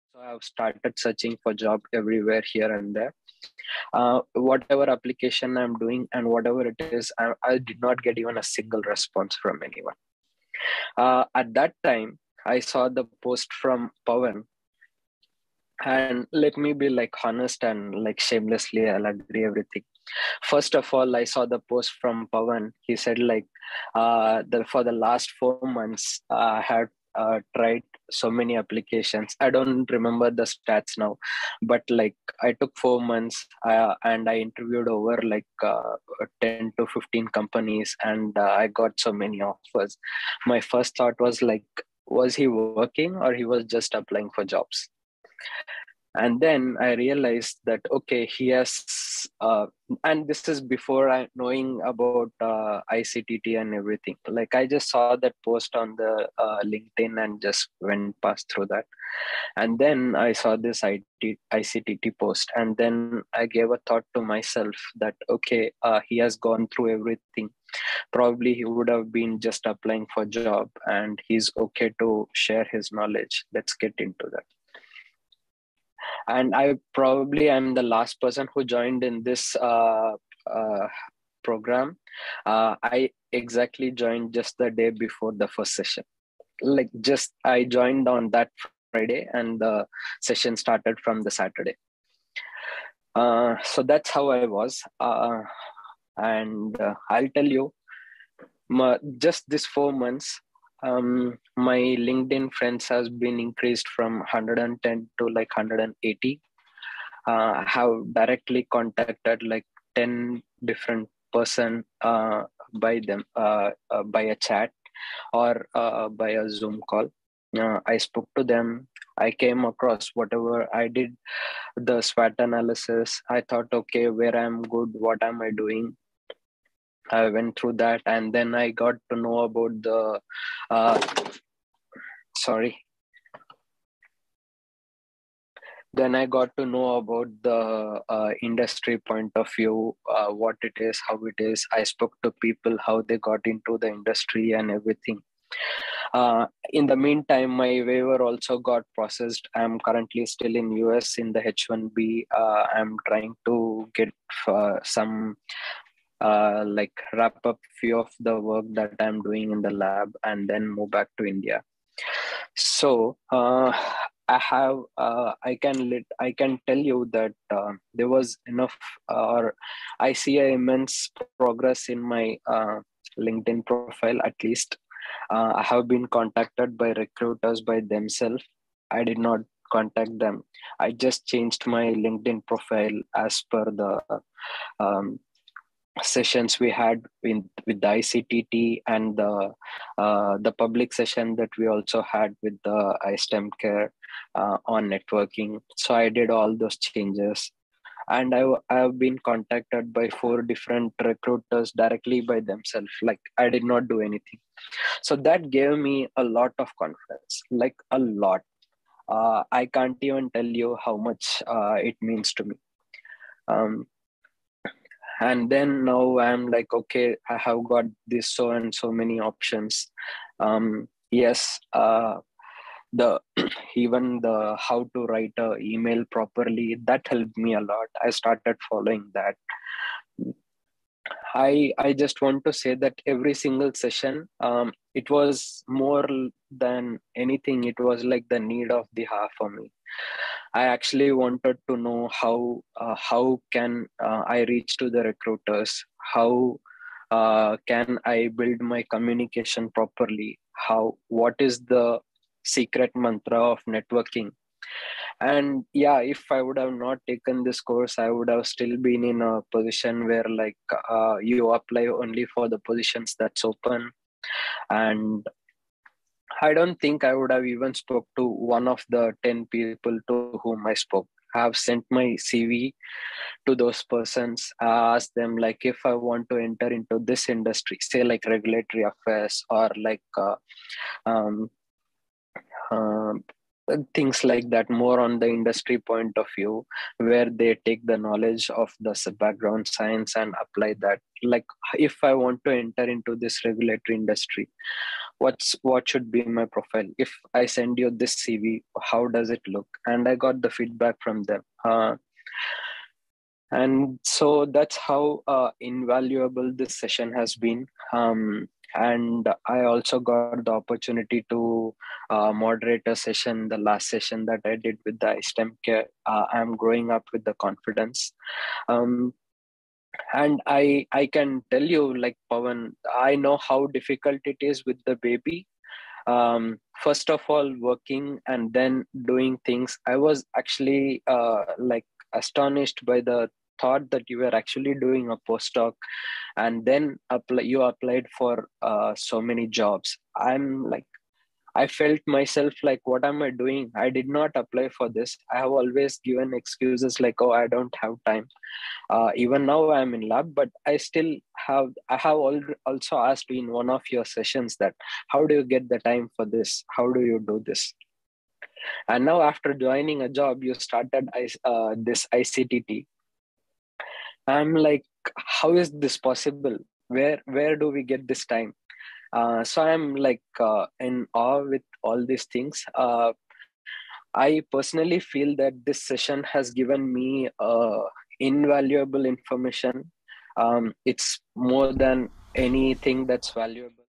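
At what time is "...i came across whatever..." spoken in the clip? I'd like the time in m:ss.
1:59.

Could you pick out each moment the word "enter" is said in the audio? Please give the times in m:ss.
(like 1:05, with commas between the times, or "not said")
4:36, 4:52.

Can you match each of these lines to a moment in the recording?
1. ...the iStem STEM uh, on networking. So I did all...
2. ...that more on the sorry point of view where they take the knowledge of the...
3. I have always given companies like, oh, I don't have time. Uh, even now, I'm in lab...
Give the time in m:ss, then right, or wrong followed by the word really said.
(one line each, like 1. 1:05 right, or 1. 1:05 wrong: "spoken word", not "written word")
1. 3:12 wrong: "Care", not "STEM"
2. 4:44 wrong: "industry", not "sorry"
3. 5:45 wrong: "excuses", not "companies".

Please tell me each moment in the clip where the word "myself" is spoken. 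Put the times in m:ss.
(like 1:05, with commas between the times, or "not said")
1:04, 5:42.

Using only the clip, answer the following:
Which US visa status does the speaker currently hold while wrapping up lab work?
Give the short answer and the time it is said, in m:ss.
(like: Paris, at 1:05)
H1B, at 2:31.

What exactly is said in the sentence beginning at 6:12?
Uh, I personally feel that this session has given me uh, invaluable information.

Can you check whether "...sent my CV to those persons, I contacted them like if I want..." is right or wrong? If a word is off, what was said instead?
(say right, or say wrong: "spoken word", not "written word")
wrong: "asked", not "contacted".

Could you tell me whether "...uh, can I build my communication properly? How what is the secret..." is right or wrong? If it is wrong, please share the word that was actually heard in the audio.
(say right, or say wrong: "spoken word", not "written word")
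right.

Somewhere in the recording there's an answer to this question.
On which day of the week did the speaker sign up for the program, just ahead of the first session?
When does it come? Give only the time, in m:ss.
1:28.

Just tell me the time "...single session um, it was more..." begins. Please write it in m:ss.
3:53.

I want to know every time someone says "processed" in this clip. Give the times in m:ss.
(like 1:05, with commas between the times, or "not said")
2:28.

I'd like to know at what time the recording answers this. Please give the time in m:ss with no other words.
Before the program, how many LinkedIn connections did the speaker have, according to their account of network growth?
1:44.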